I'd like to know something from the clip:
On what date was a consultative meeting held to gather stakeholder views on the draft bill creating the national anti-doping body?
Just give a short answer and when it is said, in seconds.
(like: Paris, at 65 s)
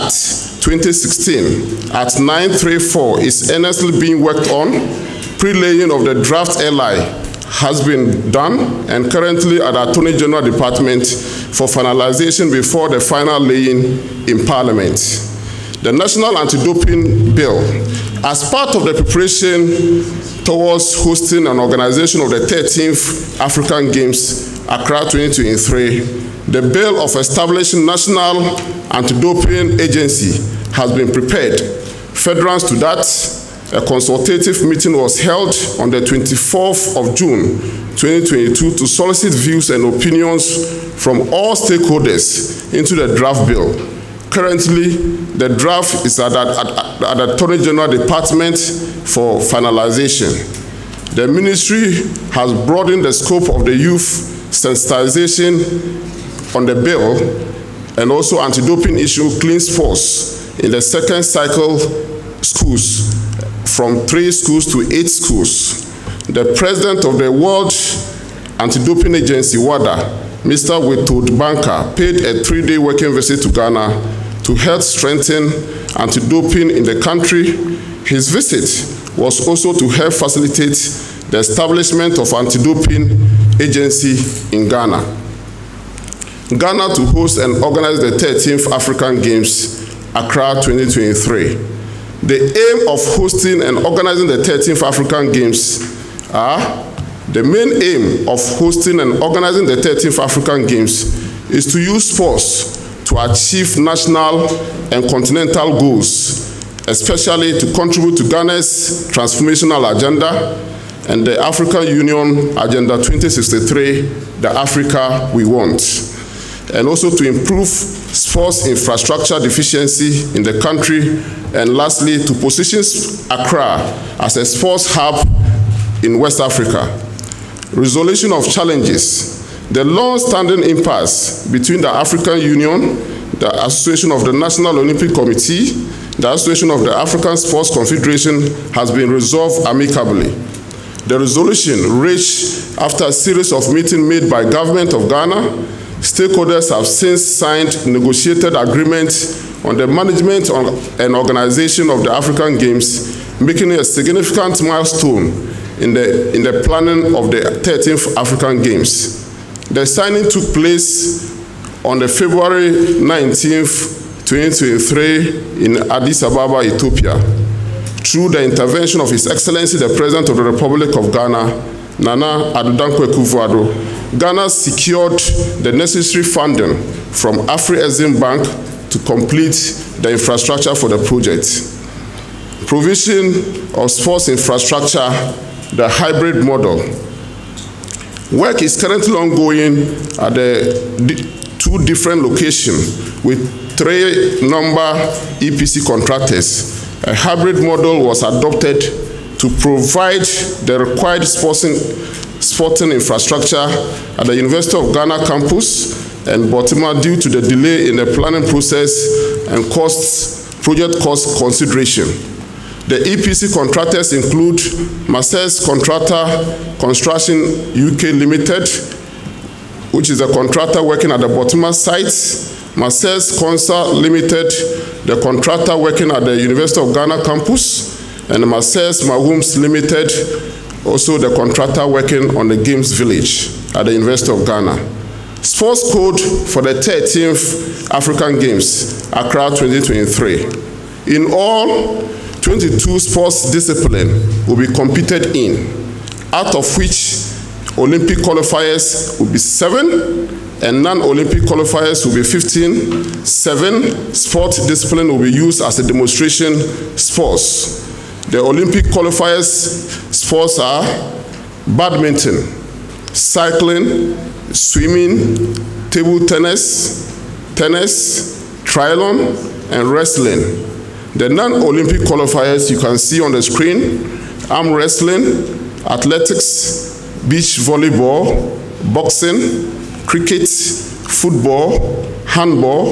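24 June 2022, at 36 s.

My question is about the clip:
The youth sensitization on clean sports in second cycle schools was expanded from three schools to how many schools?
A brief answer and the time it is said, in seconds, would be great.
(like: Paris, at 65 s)
8, at 64 s.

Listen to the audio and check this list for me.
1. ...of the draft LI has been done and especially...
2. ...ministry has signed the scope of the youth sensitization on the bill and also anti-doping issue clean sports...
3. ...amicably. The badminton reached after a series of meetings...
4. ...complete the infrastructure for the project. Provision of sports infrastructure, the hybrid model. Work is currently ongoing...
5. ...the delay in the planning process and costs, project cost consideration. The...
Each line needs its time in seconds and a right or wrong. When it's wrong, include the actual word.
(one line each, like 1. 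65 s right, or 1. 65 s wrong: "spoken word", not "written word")
1. 5 s wrong: "currently", not "especially"
2. 51 s wrong: "broadened", not "signed"
3. 139 s wrong: "resolution", not "badminton"
4. 178 s right
5. 207 s right.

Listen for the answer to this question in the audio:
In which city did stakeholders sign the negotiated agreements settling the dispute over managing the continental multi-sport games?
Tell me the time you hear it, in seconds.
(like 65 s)
165 s.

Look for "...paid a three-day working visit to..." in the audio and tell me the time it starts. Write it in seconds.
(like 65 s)
71 s.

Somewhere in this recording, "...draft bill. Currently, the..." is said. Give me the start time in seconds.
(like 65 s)
43 s.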